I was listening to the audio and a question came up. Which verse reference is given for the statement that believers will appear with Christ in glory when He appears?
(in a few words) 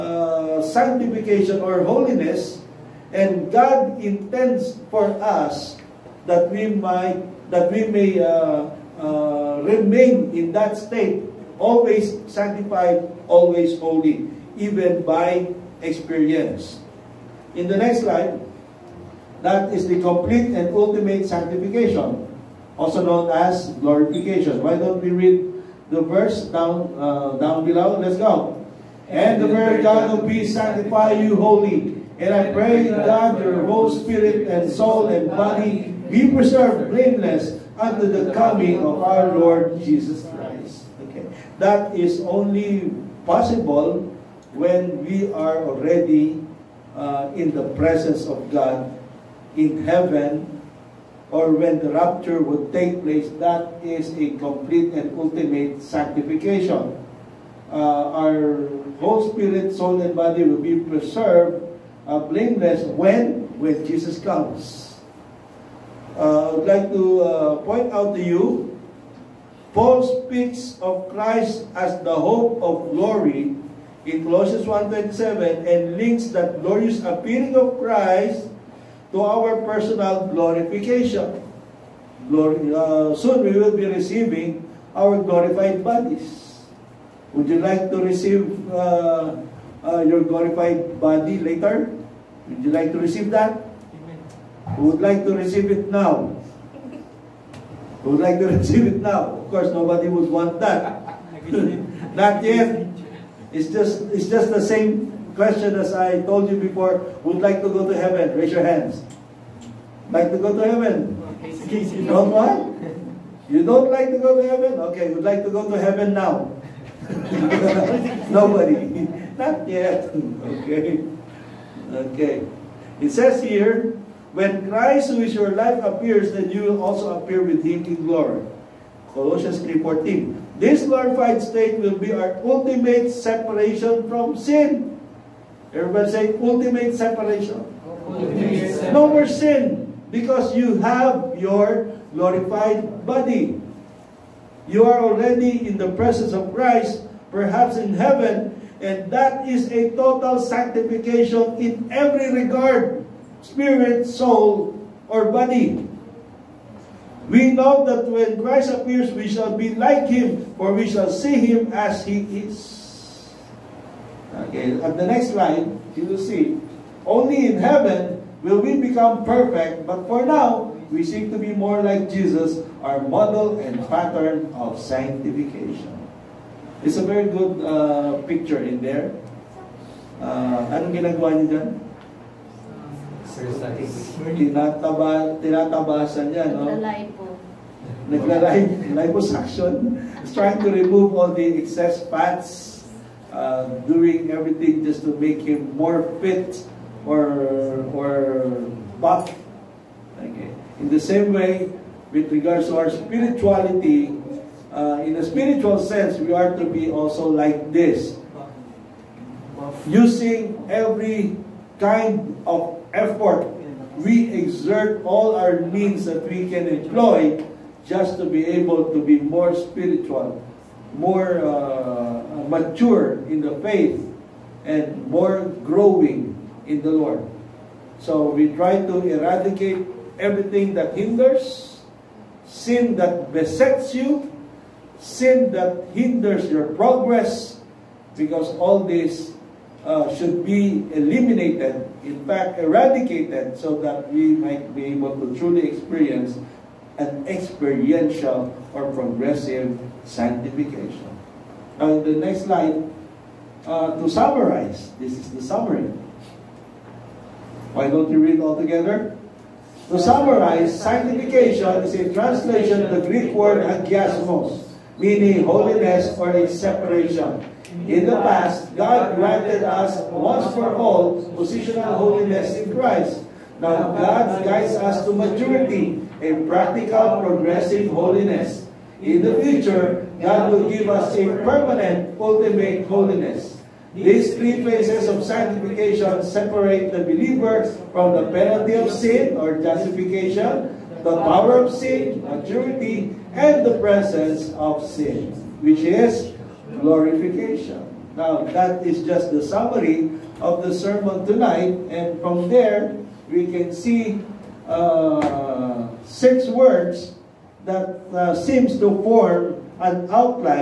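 Colossians 3:14.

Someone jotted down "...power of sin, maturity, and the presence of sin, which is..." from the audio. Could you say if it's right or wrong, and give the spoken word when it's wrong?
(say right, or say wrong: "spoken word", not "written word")
right.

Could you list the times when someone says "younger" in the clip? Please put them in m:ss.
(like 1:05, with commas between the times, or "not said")
not said.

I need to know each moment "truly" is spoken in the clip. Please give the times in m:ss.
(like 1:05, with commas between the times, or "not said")
4:05.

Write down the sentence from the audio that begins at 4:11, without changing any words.
And the next slide, uh, to summarize, this is the summary.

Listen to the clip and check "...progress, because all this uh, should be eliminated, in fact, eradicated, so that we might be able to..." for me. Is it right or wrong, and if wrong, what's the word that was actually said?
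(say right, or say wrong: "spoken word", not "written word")
right.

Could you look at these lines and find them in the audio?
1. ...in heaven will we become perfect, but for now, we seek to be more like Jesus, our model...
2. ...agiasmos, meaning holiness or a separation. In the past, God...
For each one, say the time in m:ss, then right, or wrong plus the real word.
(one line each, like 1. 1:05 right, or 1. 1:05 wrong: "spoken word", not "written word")
1. 2:47 right
2. 4:23 right.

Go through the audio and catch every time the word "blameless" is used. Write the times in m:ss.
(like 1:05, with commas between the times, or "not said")
0:36, 1:02.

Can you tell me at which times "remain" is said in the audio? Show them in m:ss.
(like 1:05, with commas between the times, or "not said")
0:09.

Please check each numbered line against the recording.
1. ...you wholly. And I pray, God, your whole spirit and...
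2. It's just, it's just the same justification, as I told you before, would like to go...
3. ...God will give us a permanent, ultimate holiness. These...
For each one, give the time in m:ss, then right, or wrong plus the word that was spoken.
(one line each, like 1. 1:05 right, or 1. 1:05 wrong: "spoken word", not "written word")
1. 0:31 right
2. 1:43 wrong: "question", not "justification"
3. 4:40 right.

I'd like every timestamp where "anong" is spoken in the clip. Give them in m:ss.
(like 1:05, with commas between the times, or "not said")
3:00.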